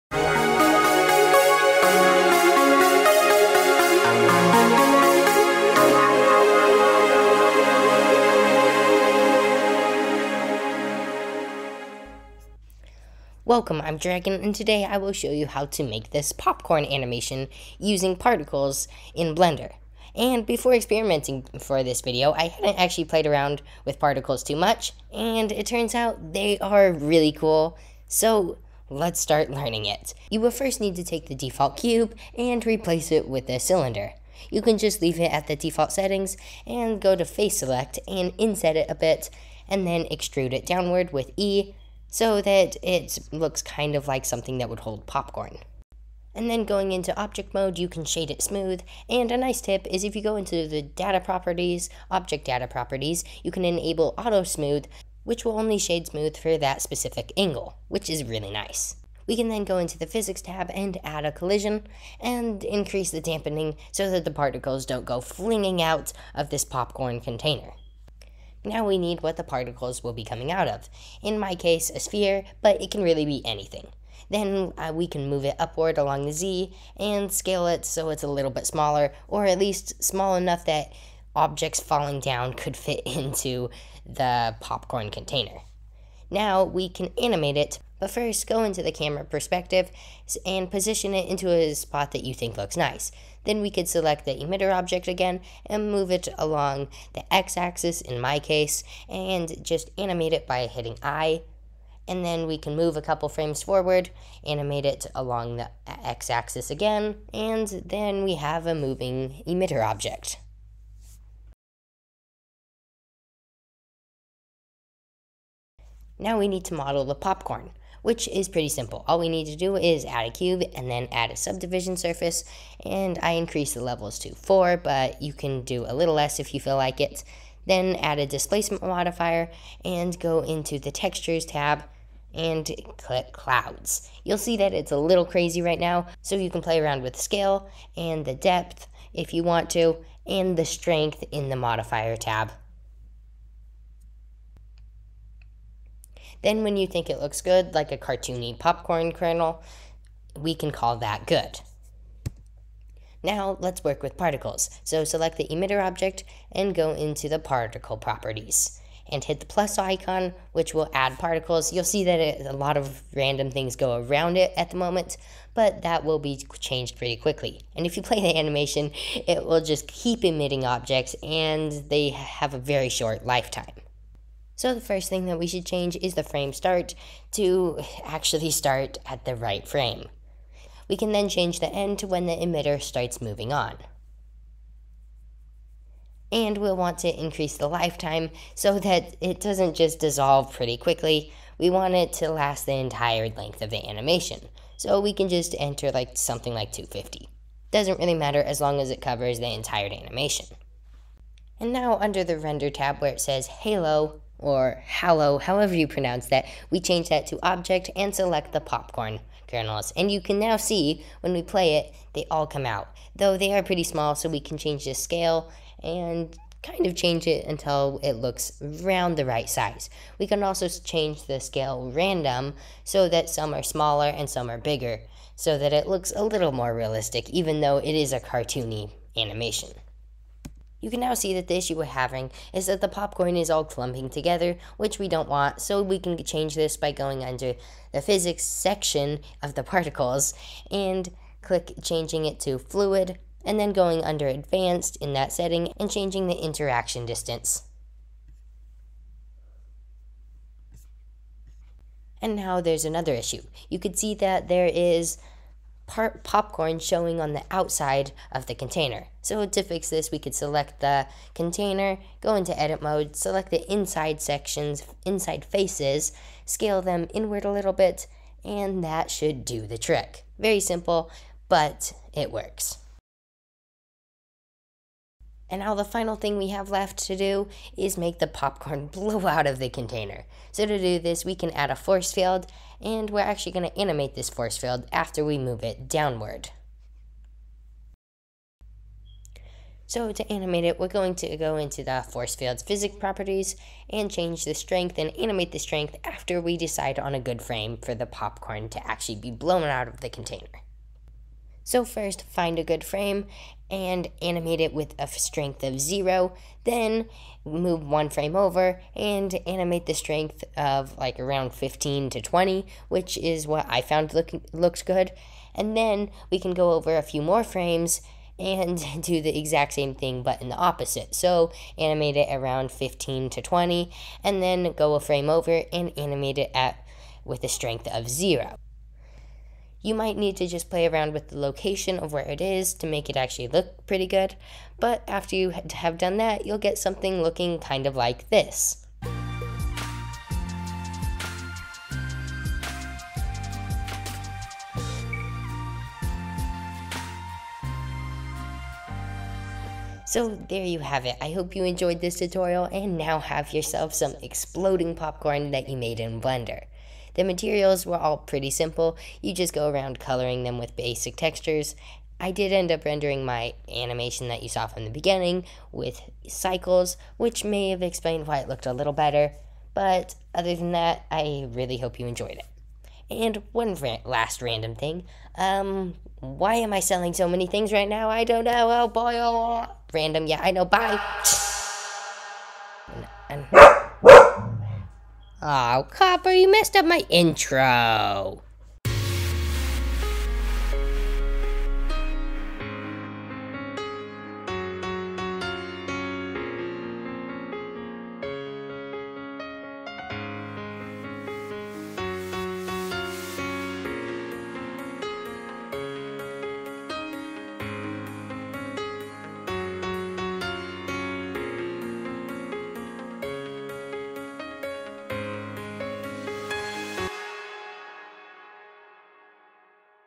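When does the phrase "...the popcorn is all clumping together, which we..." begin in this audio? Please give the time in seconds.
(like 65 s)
232 s.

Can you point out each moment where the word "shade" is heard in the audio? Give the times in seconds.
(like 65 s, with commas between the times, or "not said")
48 s, 55 s.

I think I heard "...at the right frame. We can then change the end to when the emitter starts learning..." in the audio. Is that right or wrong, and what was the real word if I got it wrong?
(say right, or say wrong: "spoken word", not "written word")
wrong: "moving", not "learning".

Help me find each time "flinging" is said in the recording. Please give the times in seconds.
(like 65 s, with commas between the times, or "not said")
65 s.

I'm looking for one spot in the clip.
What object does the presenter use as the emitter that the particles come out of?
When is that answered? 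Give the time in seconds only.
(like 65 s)
71 s.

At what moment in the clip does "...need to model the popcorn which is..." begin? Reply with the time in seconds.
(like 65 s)
116 s.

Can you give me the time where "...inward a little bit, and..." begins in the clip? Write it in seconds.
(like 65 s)
267 s.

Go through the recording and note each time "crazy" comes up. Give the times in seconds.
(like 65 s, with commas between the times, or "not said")
135 s.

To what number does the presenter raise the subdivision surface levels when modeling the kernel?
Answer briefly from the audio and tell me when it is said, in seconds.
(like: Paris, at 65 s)
4, at 124 s.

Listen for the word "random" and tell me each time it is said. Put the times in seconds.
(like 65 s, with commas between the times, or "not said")
163 s, 221 s, 374 s, 379 s.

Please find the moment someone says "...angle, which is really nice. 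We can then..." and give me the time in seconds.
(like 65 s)
57 s.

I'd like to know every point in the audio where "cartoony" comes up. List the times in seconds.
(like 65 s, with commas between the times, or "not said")
147 s, 228 s.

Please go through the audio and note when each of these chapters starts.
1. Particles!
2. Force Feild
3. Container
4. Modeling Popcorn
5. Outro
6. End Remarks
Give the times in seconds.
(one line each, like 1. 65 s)
1. 156 s
2. 280 s
3. 30 s
4. 116 s
5. 388 s
6. 338 s.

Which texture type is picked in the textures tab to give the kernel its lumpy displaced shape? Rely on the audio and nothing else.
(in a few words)
clouds.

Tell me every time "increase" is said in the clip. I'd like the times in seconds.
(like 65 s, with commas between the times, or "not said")
62 s, 123 s, 187 s.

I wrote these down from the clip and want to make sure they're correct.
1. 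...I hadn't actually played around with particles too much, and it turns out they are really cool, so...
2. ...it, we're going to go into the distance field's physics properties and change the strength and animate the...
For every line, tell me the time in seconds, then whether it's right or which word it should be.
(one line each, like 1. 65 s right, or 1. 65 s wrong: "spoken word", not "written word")
1. 22 s right
2. 290 s wrong: "force", not "distance".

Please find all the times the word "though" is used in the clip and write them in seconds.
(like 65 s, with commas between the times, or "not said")
213 s, 227 s.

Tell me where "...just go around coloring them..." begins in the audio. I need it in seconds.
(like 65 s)
359 s.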